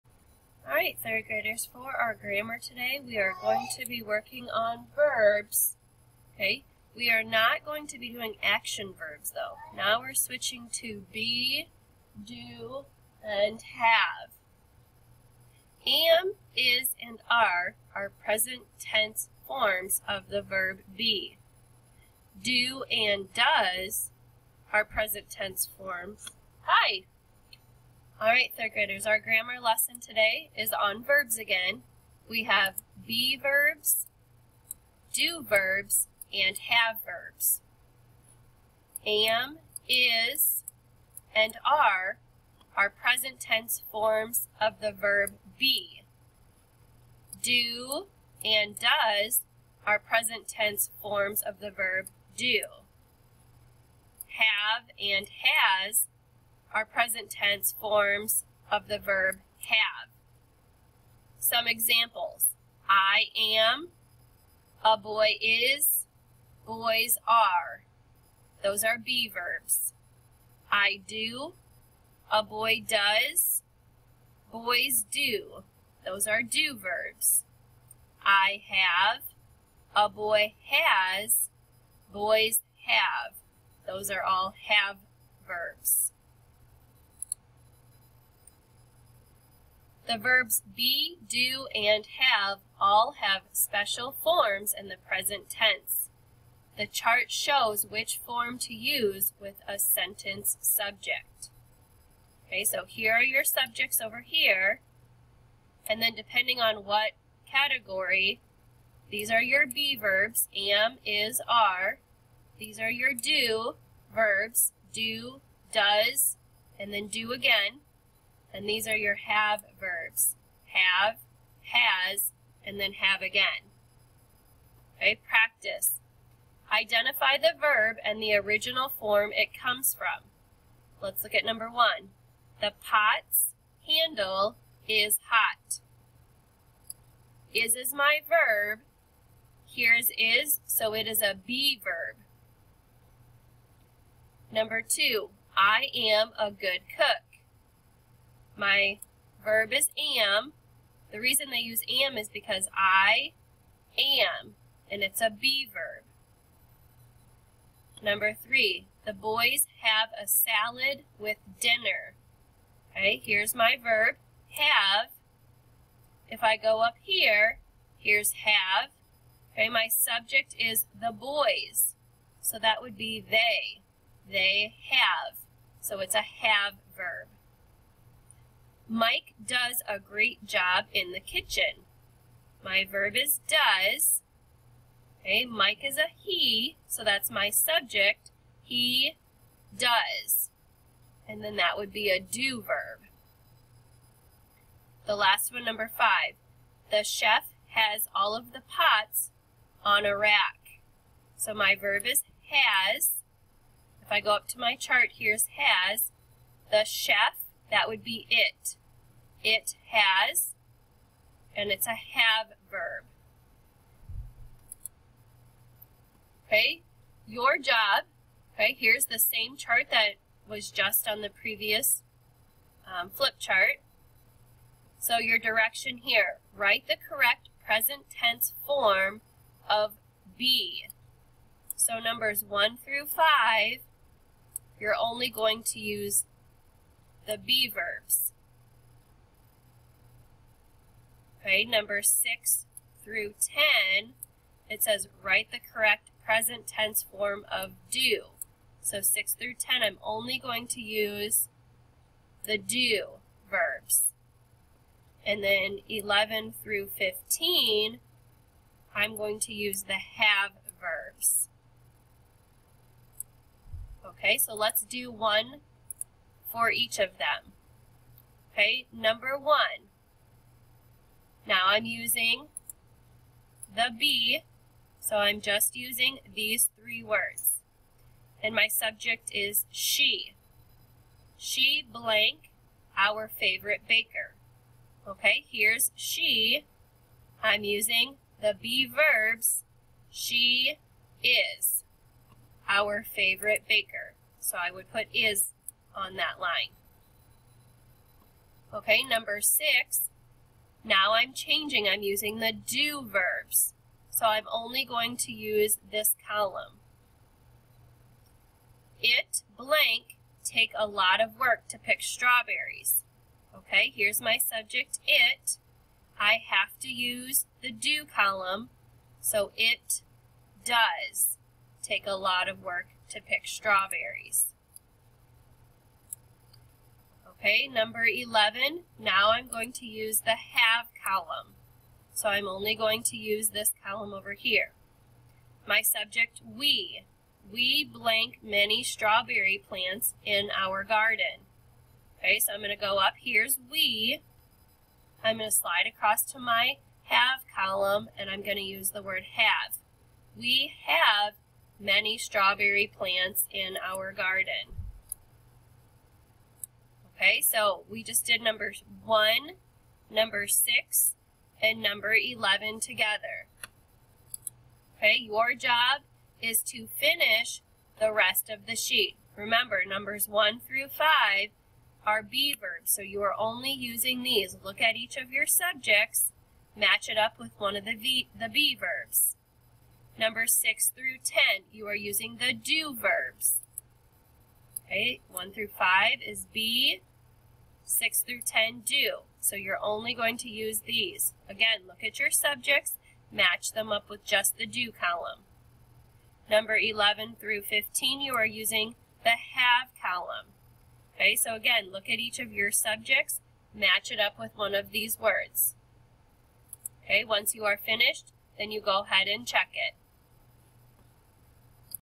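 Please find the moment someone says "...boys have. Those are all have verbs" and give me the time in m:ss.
1:22.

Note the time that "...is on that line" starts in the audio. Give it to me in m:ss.
4:55.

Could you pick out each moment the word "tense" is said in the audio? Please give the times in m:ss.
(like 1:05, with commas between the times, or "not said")
0:18, 0:25, 0:43, 0:50, 0:57, 1:35, 3:48, 4:06.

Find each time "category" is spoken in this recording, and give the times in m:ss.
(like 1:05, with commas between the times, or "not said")
1:47.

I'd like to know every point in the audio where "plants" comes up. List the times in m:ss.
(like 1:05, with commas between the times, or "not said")
5:39, 5:52.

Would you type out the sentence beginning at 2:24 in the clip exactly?
Number two, I am a good cook.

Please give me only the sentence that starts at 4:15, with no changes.
And then 11 through 15, I'm going to use the have verbs.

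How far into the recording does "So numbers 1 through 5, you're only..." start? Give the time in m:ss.
3:51.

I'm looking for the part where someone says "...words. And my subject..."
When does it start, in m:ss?
4:37.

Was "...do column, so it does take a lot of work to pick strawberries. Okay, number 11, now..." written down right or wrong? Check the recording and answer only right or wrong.
right.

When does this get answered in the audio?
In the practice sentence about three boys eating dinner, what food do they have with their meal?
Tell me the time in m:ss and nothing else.
2:40.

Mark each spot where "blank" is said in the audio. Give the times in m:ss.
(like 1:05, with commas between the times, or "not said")
4:41, 5:09, 5:37.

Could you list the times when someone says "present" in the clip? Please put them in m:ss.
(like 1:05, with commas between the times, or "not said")
0:18, 0:24, 0:42, 0:49, 0:56, 1:34, 3:47, 4:06.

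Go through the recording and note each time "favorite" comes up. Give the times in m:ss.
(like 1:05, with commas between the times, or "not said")
4:43, 4:53.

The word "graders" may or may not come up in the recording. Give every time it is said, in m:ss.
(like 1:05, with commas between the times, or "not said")
0:01, 0:28.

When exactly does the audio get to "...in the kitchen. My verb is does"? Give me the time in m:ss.
3:00.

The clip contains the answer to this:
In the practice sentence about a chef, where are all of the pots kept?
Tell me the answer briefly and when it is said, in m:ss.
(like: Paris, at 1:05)
On a rack, at 3:19.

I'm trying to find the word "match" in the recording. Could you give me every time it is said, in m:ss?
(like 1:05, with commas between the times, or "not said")
6:16, 6:33, 6:43.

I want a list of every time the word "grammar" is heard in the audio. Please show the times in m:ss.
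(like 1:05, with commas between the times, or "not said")
0:02, 0:29.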